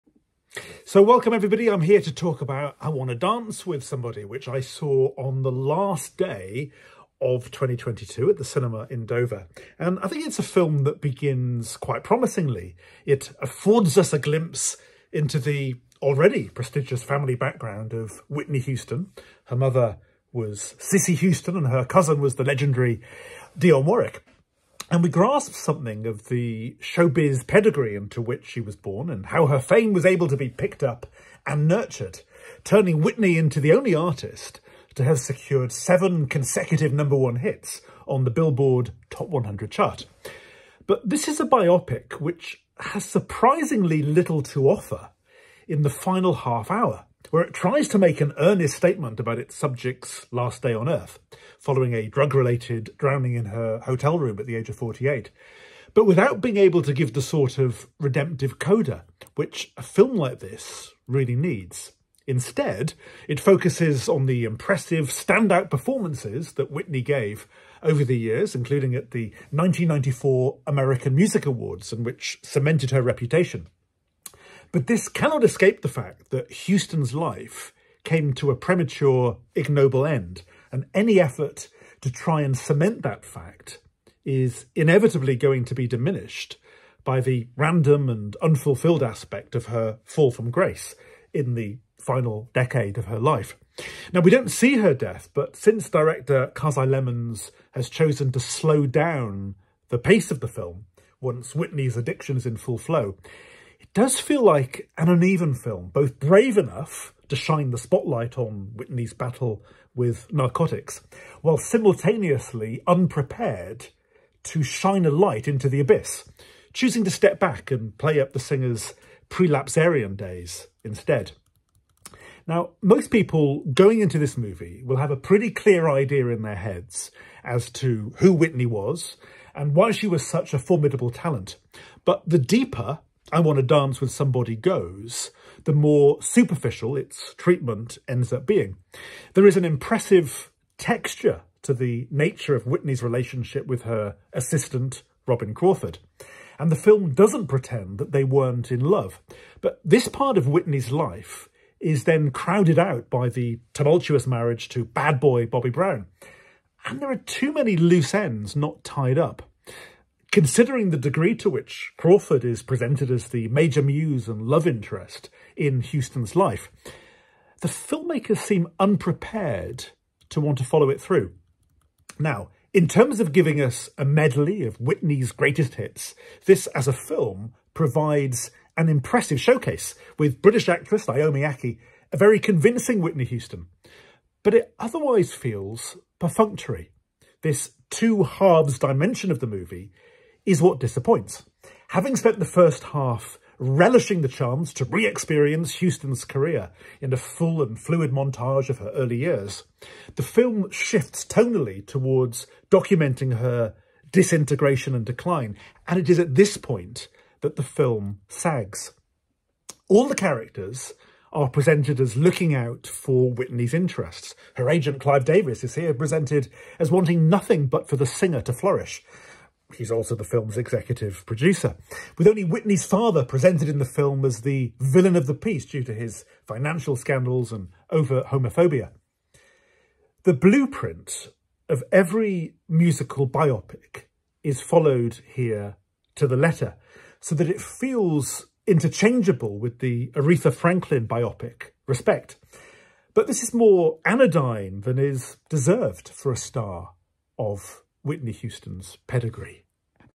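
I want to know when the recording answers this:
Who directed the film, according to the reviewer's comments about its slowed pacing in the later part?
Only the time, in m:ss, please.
1:36.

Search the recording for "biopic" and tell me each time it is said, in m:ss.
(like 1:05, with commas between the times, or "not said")
0:41, 3:53, 4:01.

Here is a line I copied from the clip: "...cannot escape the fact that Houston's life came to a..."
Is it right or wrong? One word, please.
right.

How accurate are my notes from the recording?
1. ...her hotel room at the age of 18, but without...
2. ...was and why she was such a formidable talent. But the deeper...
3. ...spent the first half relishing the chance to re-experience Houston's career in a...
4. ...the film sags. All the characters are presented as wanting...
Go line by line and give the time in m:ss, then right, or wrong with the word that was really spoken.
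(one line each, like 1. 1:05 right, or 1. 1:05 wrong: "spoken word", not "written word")
1. 0:53 wrong: "48", not "18"
2. 2:08 right
3. 3:12 right
4. 3:27 wrong: "looking", not "wanting".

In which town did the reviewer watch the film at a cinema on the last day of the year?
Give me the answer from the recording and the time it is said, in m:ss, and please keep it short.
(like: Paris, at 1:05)
Dover, at 0:09.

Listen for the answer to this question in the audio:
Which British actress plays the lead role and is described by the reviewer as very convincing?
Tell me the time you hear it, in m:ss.
3:01.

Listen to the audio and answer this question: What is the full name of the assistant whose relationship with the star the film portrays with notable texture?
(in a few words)
Robin Crawford.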